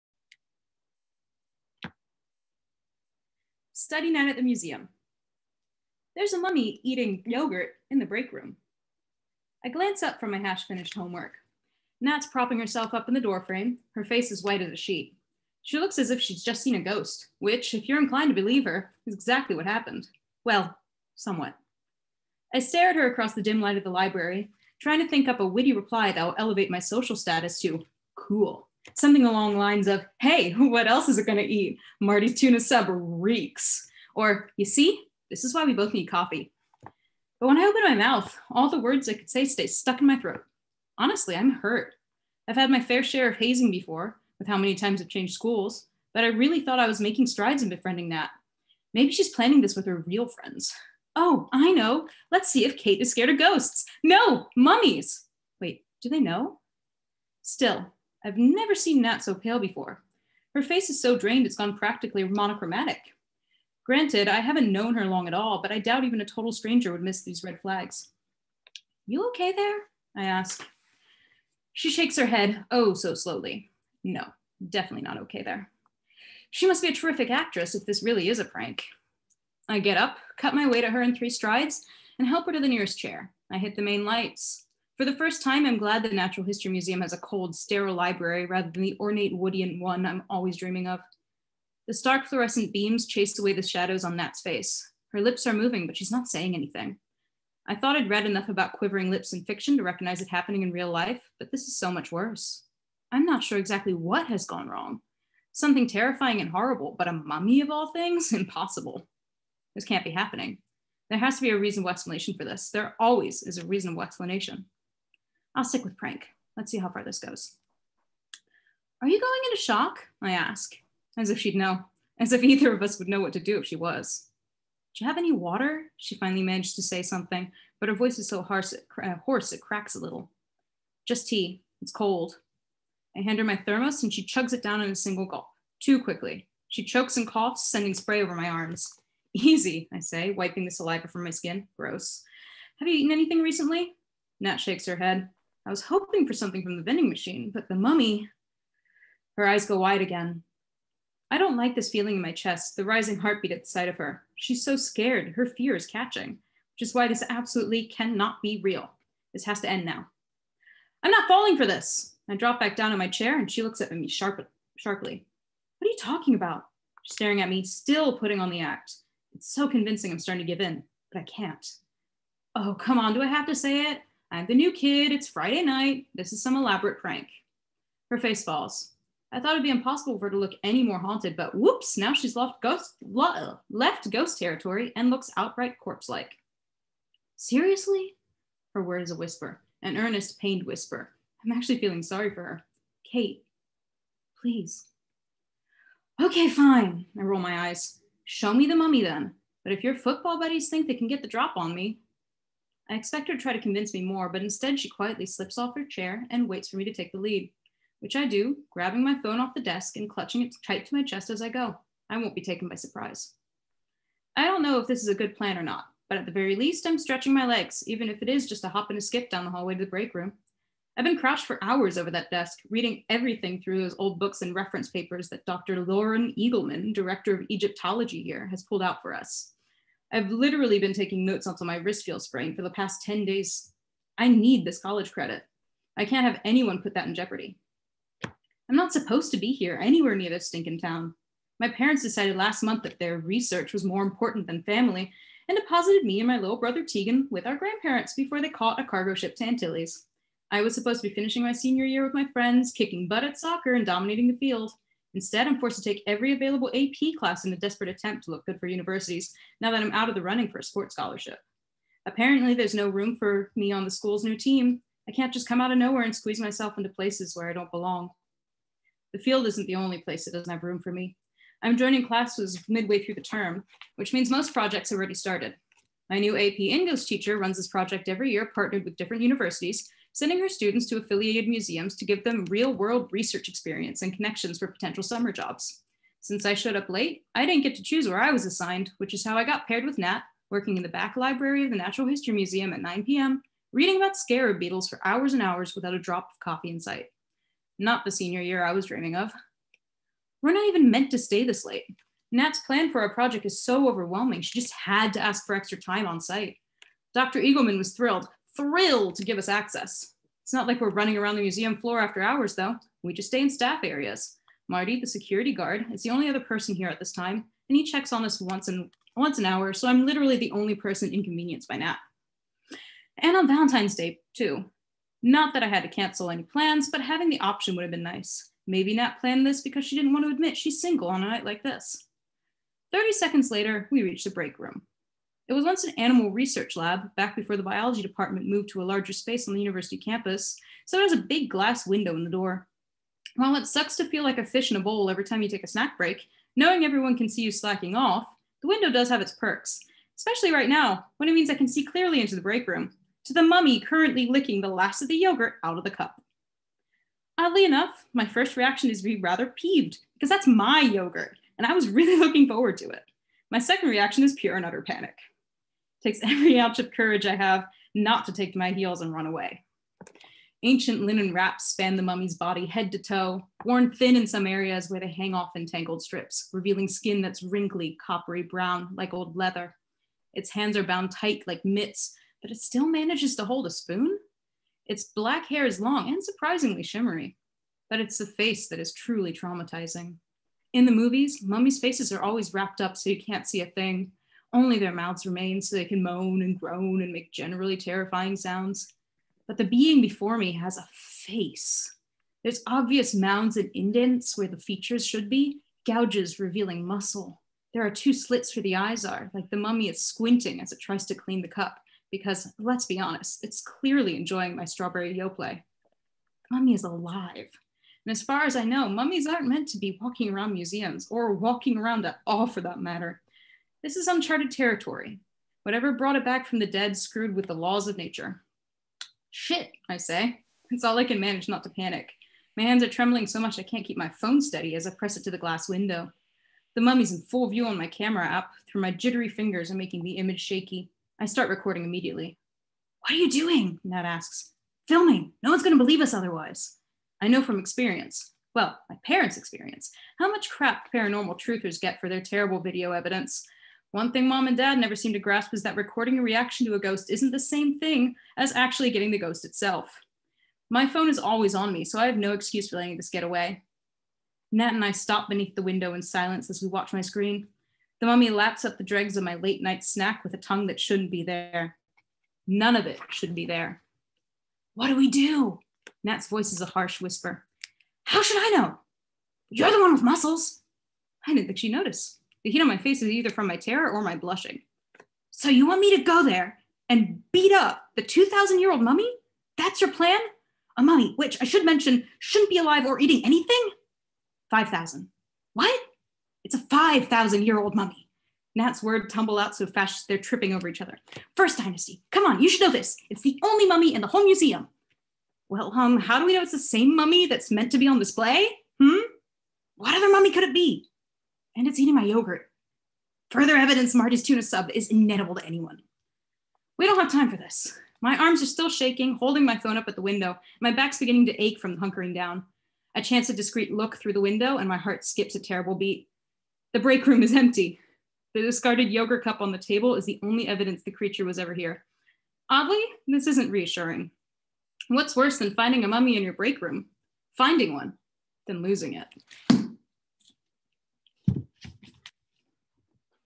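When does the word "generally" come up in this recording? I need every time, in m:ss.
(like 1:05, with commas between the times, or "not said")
6:37.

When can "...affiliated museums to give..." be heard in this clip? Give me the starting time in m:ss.
4:40.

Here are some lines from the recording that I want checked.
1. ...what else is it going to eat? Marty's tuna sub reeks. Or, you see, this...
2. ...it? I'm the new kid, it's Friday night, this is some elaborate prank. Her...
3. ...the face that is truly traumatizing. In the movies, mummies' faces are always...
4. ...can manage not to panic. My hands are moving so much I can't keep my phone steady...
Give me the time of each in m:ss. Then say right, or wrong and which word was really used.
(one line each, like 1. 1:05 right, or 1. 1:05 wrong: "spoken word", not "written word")
1. 0:30 right
2. 2:53 right
3. 6:28 right
4. 7:11 wrong: "trembling", not "moving".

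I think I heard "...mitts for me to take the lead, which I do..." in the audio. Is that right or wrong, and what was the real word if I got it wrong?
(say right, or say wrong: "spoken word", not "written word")
wrong: "waits", not "mitts".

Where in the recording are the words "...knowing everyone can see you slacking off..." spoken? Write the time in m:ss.
5:46.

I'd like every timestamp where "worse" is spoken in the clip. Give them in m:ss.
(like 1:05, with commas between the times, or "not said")
1:42, 8:55.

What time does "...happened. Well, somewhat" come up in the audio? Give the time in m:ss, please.
0:19.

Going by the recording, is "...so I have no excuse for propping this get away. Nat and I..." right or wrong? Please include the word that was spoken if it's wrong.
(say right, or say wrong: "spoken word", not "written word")
wrong: "letting", not "propping".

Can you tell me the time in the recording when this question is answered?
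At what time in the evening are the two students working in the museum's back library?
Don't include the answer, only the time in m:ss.
4:52.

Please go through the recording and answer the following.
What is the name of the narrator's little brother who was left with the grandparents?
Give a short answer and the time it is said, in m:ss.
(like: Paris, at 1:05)
Tegan, at 4:06.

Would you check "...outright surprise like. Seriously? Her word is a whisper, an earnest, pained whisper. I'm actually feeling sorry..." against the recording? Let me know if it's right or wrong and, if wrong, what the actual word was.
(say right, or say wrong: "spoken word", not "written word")
wrong: "corpse", not "surprise".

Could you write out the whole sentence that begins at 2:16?
She chokes and coughs, sending spray over my arms.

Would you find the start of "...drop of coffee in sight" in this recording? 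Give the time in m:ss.
4:55.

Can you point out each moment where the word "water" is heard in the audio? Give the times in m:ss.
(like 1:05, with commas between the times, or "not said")
2:05.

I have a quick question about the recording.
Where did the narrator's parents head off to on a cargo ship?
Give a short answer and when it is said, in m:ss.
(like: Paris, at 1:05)
Antilles, at 4:09.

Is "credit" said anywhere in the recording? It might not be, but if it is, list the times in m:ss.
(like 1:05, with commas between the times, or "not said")
3:55.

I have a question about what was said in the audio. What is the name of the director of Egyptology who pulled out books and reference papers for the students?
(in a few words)
Dr. Lauren Eagleman.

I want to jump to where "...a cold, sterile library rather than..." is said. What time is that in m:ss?
1:27.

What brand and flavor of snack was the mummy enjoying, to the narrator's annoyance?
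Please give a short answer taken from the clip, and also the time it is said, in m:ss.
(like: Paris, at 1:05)
Strawberry Yoplait, at 6:54.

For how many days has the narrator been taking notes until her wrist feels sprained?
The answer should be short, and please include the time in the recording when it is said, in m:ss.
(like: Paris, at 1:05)
10, at 3:53.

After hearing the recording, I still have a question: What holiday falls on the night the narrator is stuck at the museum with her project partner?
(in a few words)
Valentine's Day.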